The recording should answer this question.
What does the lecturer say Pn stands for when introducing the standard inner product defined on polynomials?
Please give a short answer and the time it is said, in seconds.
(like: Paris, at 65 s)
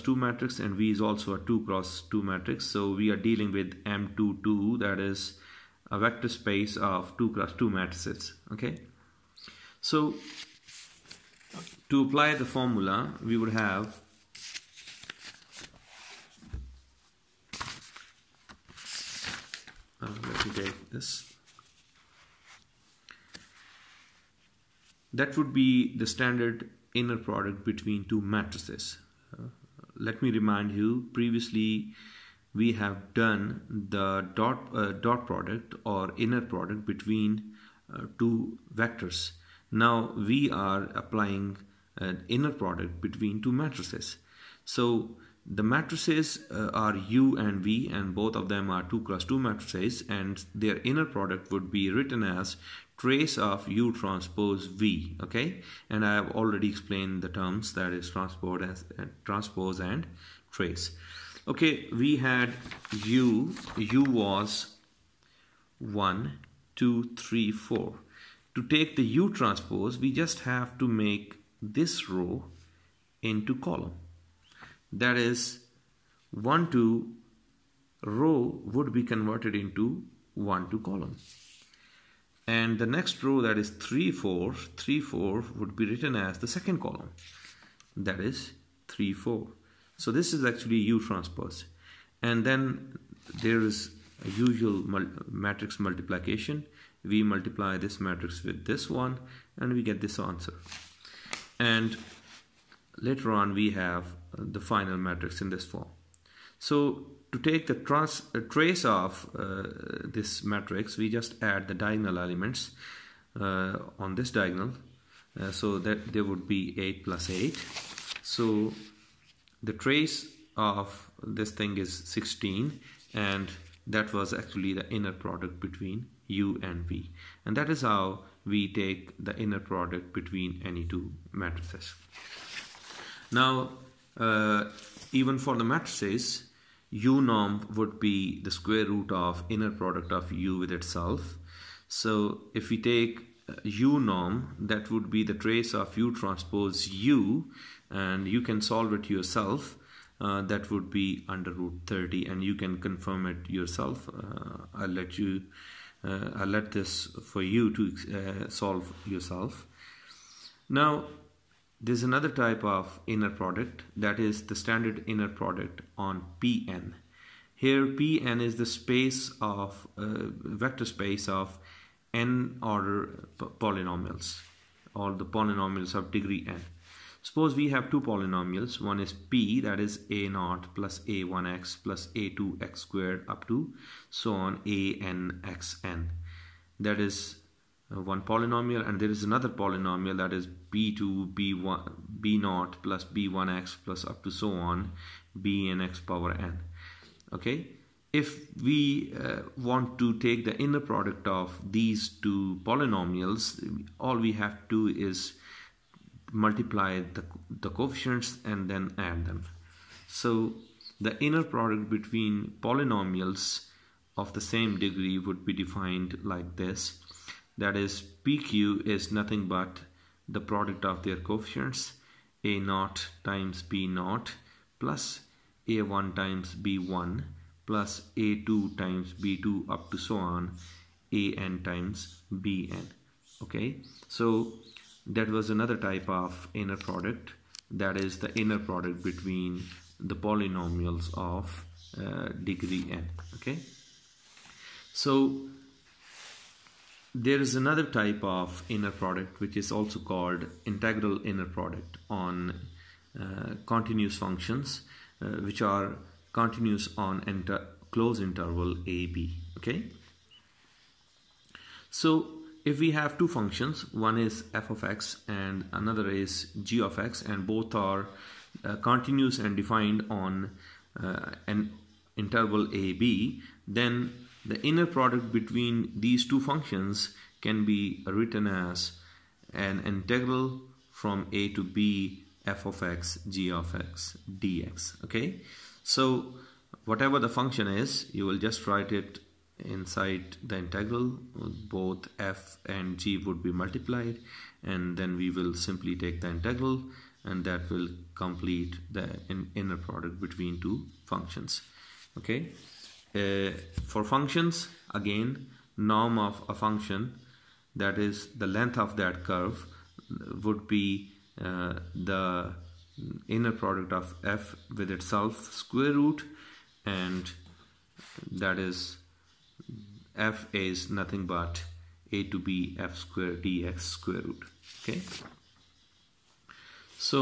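vector space of n order polynomials, at 170 s.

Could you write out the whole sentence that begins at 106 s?
So to take the trans, uh, trace of uh, this matrix, we just add the diagonal elements uh, on this diagonal.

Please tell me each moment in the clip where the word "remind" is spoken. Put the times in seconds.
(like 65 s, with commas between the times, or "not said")
30 s.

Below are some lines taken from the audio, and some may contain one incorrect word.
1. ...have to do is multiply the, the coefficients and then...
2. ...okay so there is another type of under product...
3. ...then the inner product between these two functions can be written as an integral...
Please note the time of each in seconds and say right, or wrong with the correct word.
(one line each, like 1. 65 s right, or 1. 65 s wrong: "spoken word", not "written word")
1. 204 s right
2. 243 s wrong: "inner", not "under"
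3. 273 s right.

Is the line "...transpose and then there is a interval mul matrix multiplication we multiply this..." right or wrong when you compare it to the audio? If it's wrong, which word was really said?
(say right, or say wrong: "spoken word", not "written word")
wrong: "usual", not "interval".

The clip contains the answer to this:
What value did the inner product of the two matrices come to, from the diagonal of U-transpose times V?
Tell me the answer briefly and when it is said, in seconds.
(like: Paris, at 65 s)
16, at 122 s.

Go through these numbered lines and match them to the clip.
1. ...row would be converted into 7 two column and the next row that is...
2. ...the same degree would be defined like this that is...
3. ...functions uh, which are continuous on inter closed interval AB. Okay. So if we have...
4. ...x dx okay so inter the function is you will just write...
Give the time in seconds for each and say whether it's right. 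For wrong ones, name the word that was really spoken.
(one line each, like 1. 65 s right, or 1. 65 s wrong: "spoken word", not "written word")
1. 78 s wrong: "1", not "7"
2. 214 s right
3. 254 s right
4. 283 s wrong: "whatever", not "inter".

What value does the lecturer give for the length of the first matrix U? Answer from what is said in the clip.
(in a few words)
square root of 30.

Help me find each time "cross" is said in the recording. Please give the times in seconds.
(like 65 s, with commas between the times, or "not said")
1 s, 7 s, 49 s.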